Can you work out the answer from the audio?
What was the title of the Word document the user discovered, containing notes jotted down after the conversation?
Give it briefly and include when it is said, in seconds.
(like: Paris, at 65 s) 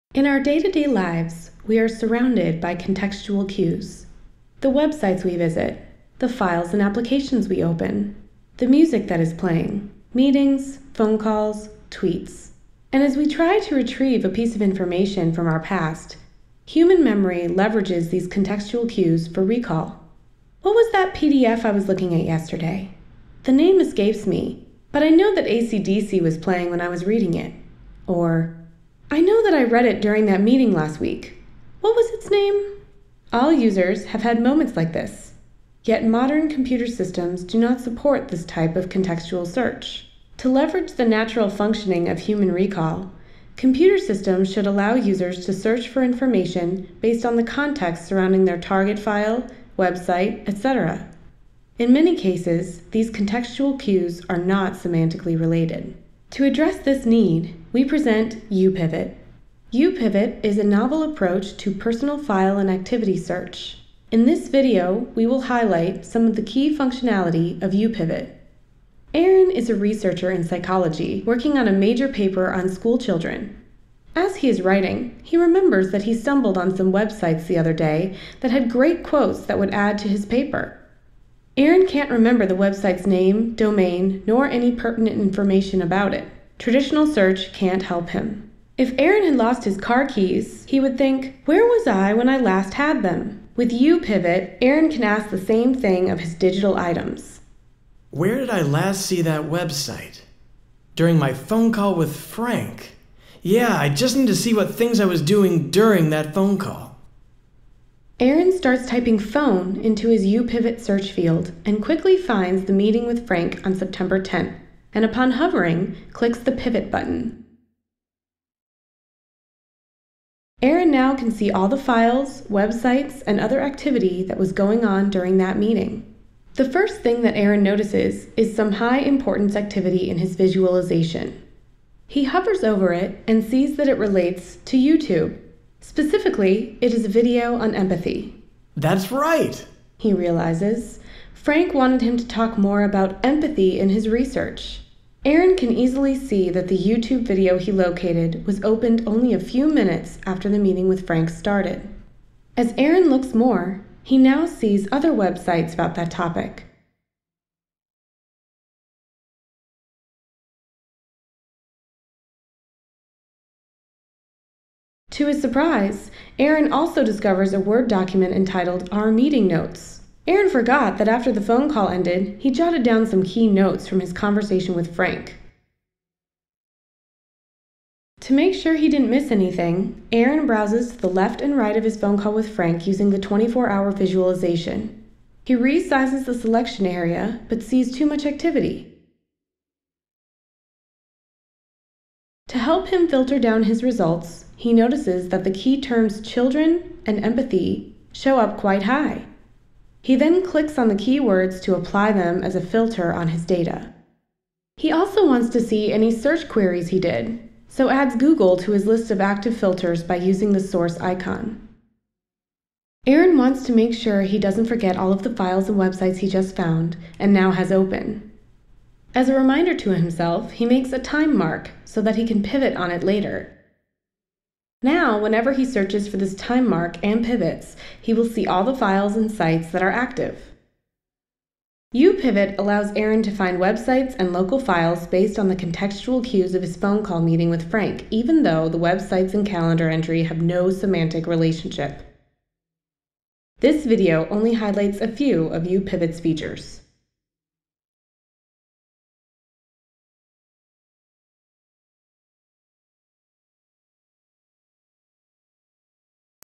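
Our Meeting Notes, at 168 s.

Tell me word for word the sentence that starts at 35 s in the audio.
Yet modern computer systems do not support this type of contextual search.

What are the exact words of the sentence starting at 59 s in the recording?
YouPivot is a novel approach to personal file and activity search.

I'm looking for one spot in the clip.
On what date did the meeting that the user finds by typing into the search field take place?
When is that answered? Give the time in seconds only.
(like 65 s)
113 s.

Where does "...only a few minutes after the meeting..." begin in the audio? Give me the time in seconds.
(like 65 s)
149 s.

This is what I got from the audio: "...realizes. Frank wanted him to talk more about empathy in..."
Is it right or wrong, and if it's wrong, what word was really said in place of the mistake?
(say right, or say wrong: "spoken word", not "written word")
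right.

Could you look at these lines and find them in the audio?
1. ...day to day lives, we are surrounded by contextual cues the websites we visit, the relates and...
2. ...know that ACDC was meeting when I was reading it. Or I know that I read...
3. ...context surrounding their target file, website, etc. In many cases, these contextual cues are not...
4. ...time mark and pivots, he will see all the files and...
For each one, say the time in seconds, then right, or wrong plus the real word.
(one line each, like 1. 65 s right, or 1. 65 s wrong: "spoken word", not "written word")
1. 0 s wrong: "files", not "relates"
2. 25 s wrong: "playing", not "meeting"
3. 47 s right
4. 226 s right.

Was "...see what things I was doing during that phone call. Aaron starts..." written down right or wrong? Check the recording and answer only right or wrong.
right.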